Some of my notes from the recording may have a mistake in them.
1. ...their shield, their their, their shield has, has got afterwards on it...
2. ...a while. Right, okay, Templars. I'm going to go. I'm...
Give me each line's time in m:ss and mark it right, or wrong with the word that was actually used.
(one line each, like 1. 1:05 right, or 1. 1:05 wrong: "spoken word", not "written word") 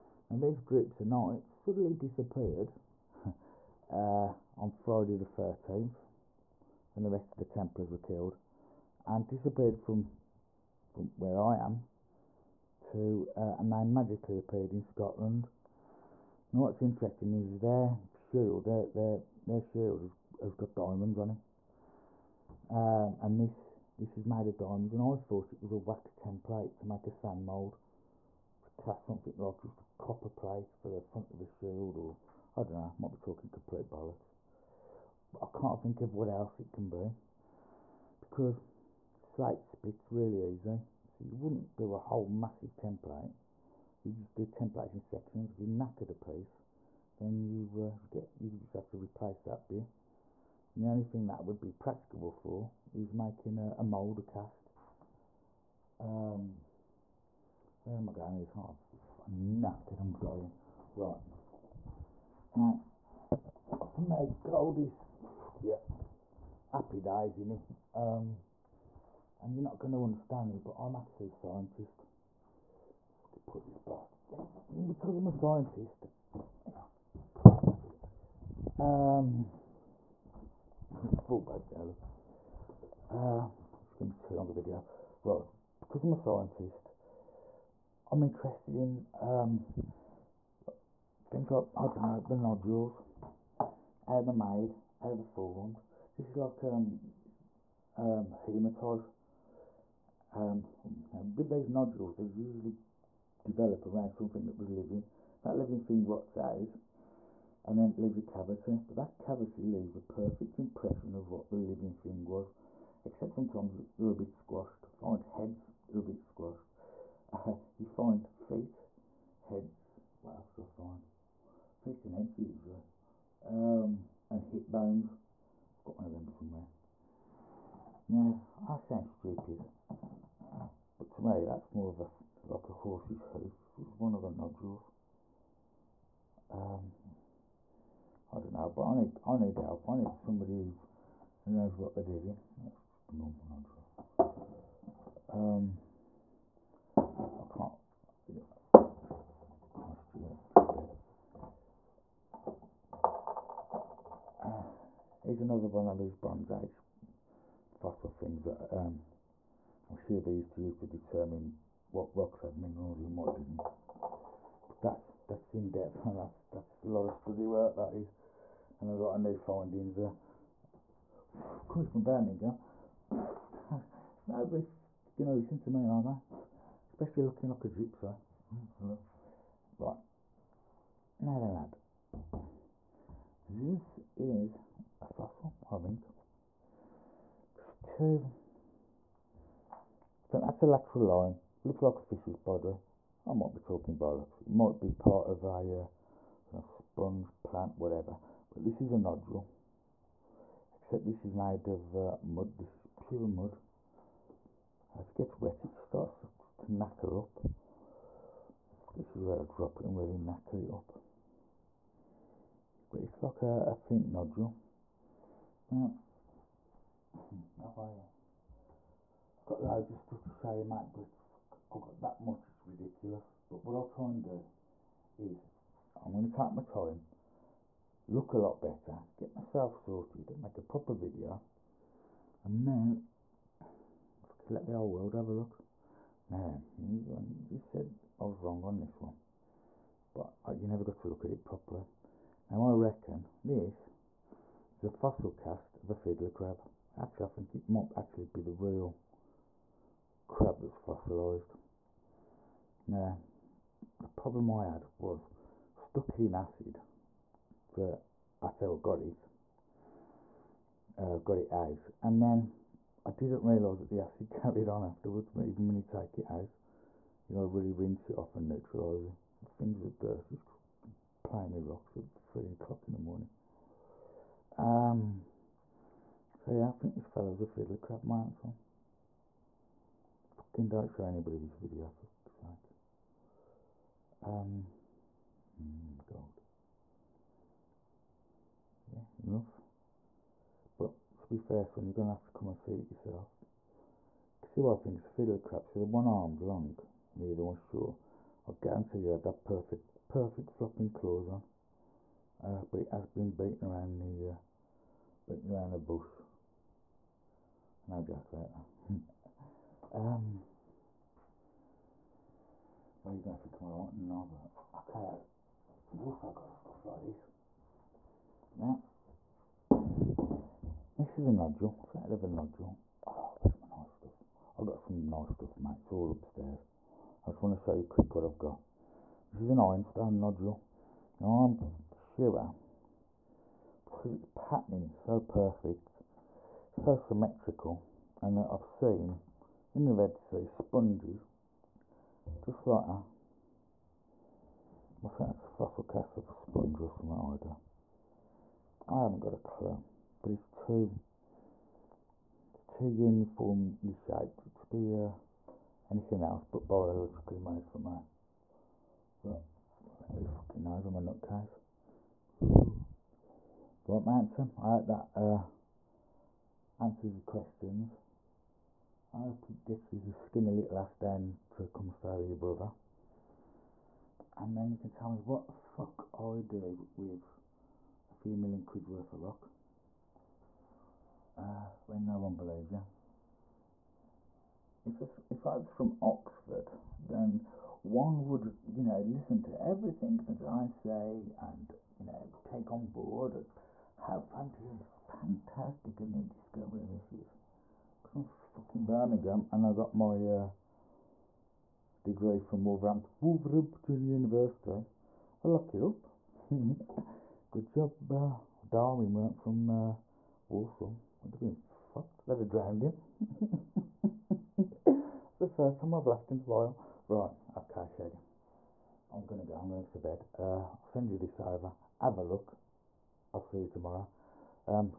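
1. 0:17 wrong: "diamonds", not "afterwards"
2. 6:56 wrong: "Shaggy", not "Templars".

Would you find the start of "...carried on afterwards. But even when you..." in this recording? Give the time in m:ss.
4:24.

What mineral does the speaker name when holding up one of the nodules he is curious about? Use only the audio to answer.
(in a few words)
Hematite.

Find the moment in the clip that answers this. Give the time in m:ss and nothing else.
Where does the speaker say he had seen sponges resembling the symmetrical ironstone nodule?
5:39.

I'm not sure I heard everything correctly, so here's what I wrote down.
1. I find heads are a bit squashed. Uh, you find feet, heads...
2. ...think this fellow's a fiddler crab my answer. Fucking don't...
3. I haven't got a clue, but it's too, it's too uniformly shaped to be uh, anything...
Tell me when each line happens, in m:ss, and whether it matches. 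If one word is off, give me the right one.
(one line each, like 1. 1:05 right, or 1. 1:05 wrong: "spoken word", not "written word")
1. 1:54 right
2. 4:36 right
3. 5:48 right.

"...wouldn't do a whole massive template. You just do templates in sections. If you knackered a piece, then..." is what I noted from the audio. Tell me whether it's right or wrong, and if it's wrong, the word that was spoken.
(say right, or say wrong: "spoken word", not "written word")
right.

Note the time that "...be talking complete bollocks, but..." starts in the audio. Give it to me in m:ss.
0:33.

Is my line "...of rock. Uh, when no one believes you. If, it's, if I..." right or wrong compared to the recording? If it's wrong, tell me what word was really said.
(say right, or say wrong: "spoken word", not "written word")
right.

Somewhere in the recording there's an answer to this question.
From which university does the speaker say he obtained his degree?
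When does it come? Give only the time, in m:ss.
6:43.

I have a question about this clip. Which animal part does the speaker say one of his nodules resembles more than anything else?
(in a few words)
A horse's hoof.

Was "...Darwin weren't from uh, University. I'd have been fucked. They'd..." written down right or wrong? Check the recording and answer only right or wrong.
wrong.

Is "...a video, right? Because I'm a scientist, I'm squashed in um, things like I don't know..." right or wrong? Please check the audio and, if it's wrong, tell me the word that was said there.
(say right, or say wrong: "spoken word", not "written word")
wrong: "interested", not "squashed".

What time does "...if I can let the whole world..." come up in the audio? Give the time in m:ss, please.
3:53.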